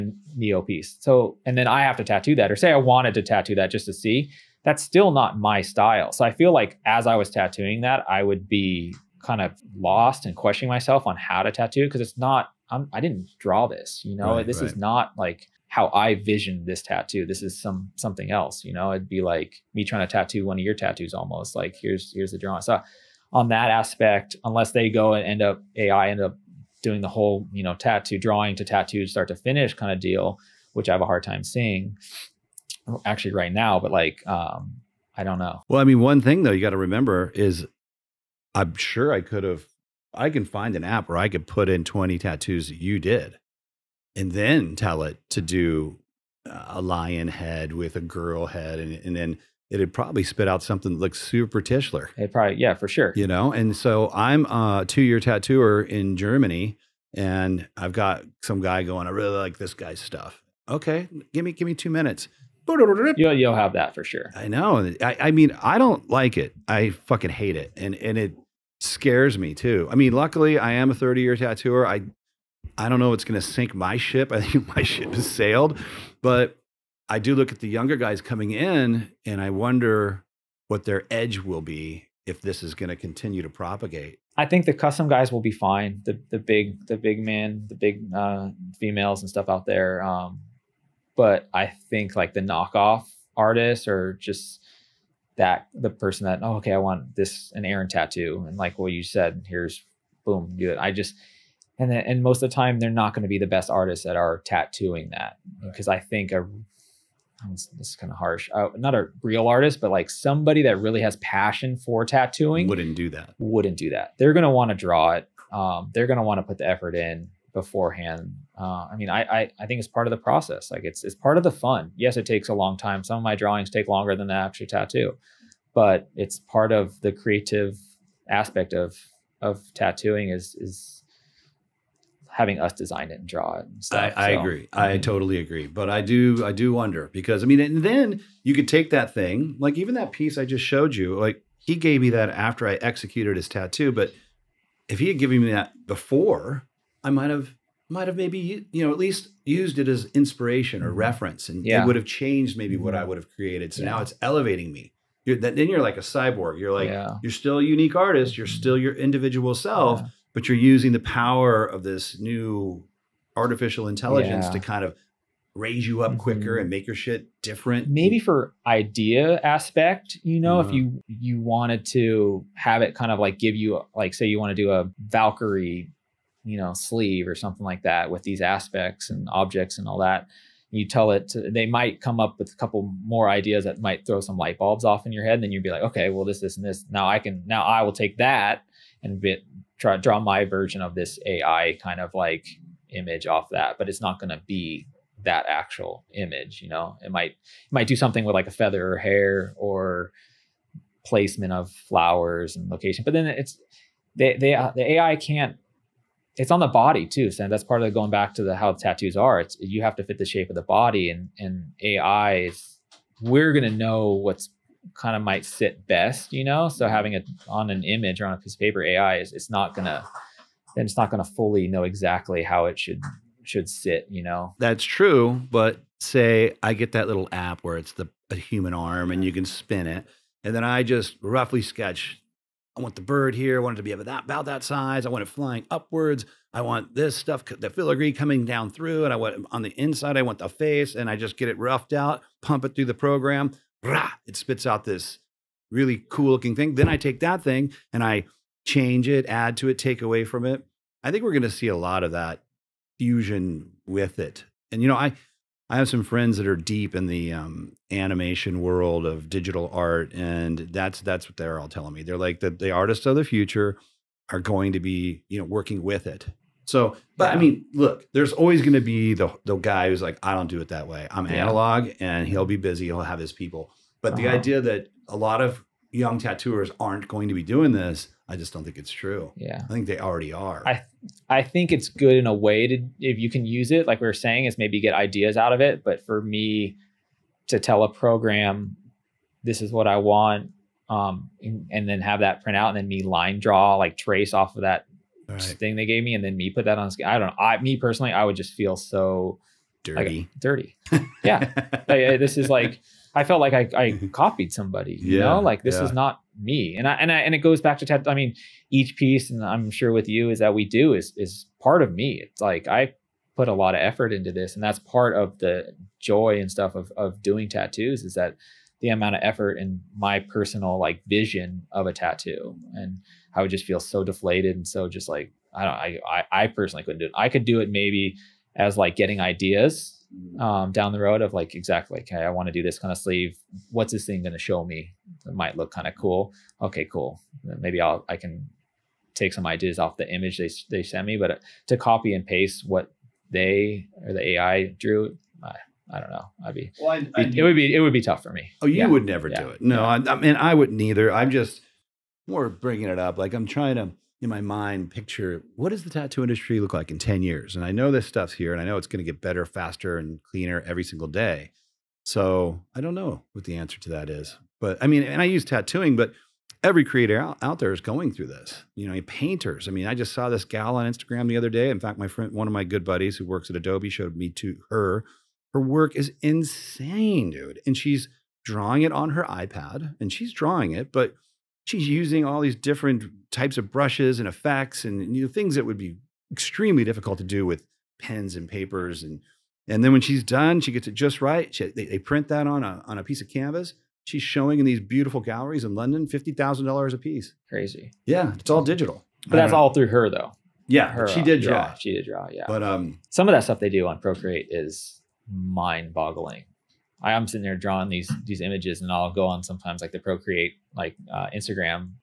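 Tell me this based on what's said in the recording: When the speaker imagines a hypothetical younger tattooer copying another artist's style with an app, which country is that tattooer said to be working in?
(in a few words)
Germany.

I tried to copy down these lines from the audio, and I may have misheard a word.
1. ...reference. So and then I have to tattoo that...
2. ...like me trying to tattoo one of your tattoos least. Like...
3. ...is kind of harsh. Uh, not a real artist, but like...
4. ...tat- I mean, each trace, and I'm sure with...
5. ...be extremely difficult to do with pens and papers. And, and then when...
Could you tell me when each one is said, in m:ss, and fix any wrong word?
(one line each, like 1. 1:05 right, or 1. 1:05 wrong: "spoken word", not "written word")
1. 0:00 wrong: "piece", not "reference"
2. 0:19 wrong: "almost", not "least"
3. 1:47 right
4. 5:07 wrong: "piece", not "trace"
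5. 6:25 right.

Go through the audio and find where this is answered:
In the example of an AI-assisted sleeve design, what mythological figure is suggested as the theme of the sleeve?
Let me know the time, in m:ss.
2:55.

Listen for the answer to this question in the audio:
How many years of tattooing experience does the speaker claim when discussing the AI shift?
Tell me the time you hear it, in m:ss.
1:10.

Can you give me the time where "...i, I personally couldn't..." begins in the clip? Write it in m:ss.
5:26.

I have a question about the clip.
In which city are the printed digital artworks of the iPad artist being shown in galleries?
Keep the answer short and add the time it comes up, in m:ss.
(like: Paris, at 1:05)
London, at 6:35.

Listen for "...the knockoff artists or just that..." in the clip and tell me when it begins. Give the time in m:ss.
1:32.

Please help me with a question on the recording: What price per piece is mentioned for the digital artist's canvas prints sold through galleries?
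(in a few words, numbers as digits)
$50,000.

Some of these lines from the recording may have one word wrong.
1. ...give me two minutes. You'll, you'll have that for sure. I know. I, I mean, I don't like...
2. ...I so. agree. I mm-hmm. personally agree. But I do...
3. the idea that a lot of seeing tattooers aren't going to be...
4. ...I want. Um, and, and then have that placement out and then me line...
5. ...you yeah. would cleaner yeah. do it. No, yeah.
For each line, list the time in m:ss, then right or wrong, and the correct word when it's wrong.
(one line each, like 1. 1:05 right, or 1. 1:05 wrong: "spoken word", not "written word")
1. 1:01 right
2. 2:14 wrong: "totally", not "personally"
3. 4:34 wrong: "young", not "seeing"
4. 4:49 wrong: "print", not "placement"
5. 5:48 wrong: "never", not "cleaner".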